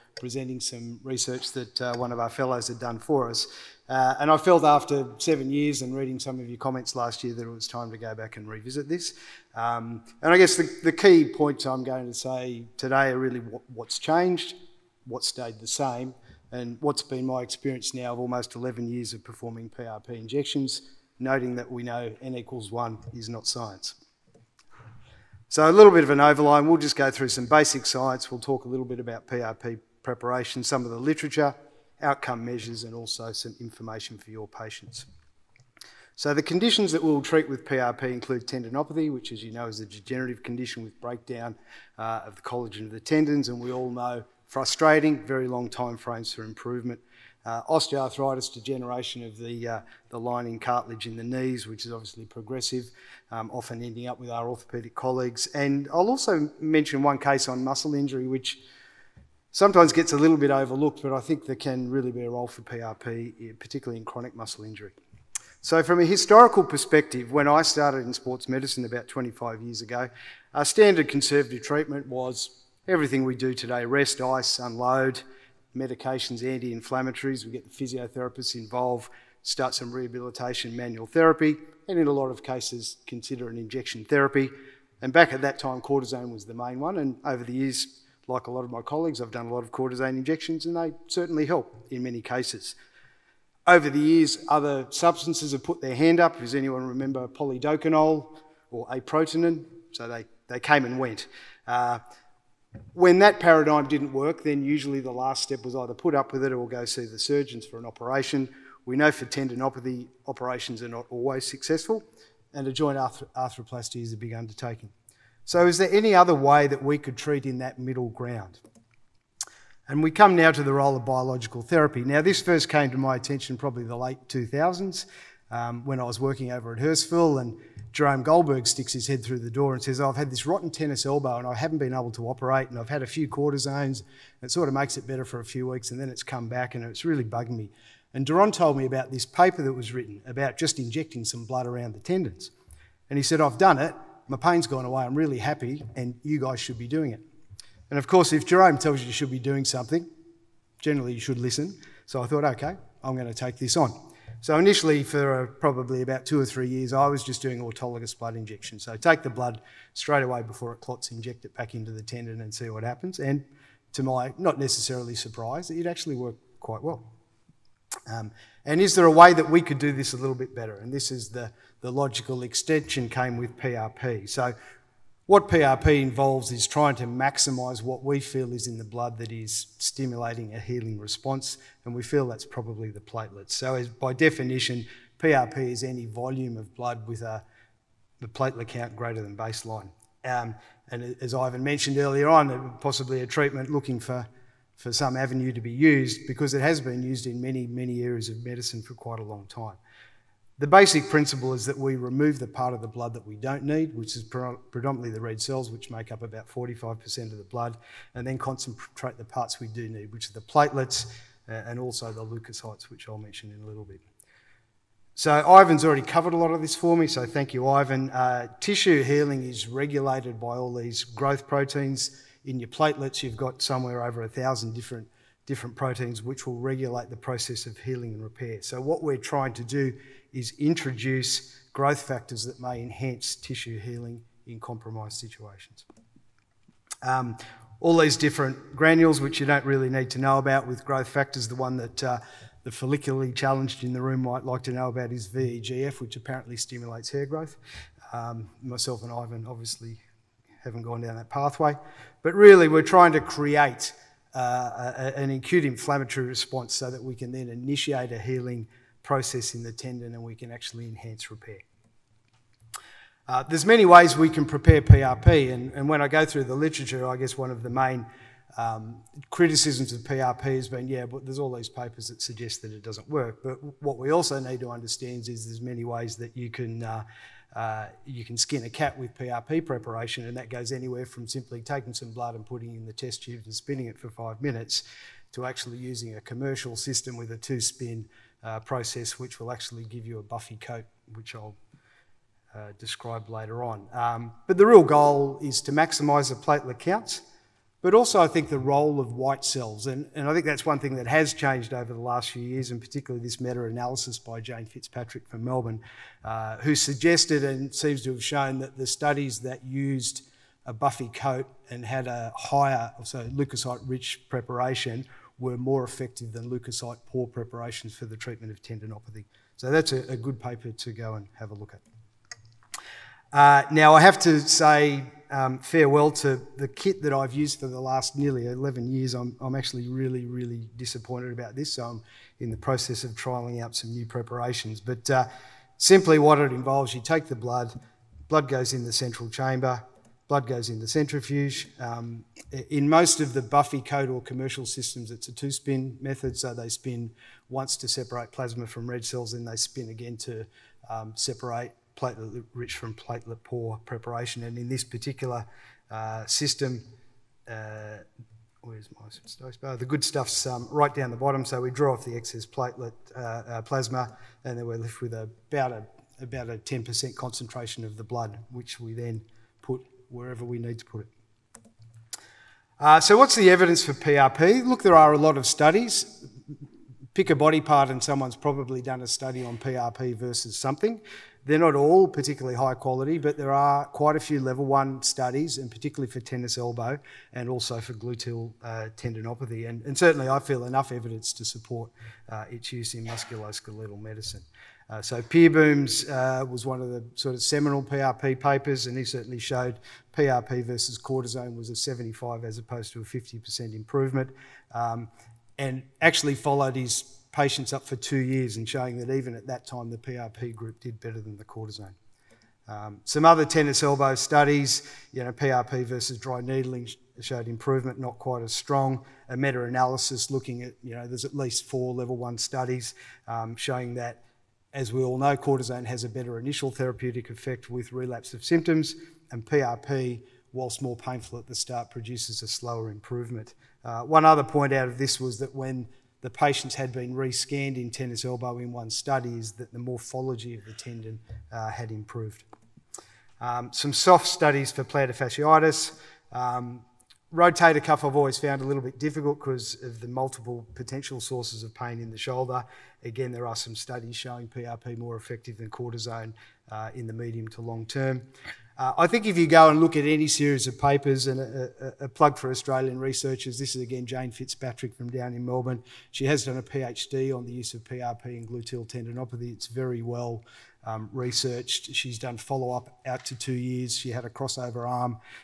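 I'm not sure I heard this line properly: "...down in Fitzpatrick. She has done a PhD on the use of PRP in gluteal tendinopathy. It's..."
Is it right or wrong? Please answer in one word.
wrong.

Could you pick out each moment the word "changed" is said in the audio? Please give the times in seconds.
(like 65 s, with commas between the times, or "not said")
13 s, 301 s.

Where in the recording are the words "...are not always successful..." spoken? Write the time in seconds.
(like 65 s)
110 s.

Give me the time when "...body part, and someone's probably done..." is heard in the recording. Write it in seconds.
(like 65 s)
377 s.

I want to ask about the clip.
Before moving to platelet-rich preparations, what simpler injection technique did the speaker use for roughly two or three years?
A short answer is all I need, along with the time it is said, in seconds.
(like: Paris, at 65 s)
autologous blood injection, at 157 s.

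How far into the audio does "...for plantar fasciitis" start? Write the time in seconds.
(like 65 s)
444 s.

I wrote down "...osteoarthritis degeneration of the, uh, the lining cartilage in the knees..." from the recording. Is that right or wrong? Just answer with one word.
right.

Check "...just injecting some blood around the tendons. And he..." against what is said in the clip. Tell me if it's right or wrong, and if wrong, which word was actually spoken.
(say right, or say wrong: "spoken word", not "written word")
right.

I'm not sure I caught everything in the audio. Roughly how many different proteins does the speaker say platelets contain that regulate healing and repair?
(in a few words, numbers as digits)
over a thousand.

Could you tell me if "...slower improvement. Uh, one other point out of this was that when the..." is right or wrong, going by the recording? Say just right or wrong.
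right.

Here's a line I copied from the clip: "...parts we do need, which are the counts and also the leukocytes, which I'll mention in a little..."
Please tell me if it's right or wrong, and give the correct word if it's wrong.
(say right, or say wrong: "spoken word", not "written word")
wrong: "platelets", not "counts".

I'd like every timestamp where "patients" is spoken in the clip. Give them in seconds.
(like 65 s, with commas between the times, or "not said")
34 s, 407 s, 436 s.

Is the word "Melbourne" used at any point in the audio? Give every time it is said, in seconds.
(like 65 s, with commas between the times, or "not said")
305 s, 465 s.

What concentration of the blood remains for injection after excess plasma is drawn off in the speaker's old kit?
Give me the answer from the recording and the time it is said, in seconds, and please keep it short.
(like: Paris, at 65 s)
10%, at 366 s.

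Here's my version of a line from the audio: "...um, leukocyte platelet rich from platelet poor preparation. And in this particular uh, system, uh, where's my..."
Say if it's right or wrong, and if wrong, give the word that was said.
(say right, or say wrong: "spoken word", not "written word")
wrong: "separate", not "leukocyte".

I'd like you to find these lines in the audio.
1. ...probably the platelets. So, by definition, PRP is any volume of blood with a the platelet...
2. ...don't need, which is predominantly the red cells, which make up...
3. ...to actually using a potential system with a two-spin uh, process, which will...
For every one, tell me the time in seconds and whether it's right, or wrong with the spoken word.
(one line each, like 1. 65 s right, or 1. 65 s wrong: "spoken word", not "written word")
1. 182 s right
2. 203 s right
3. 285 s wrong: "commercial", not "potential".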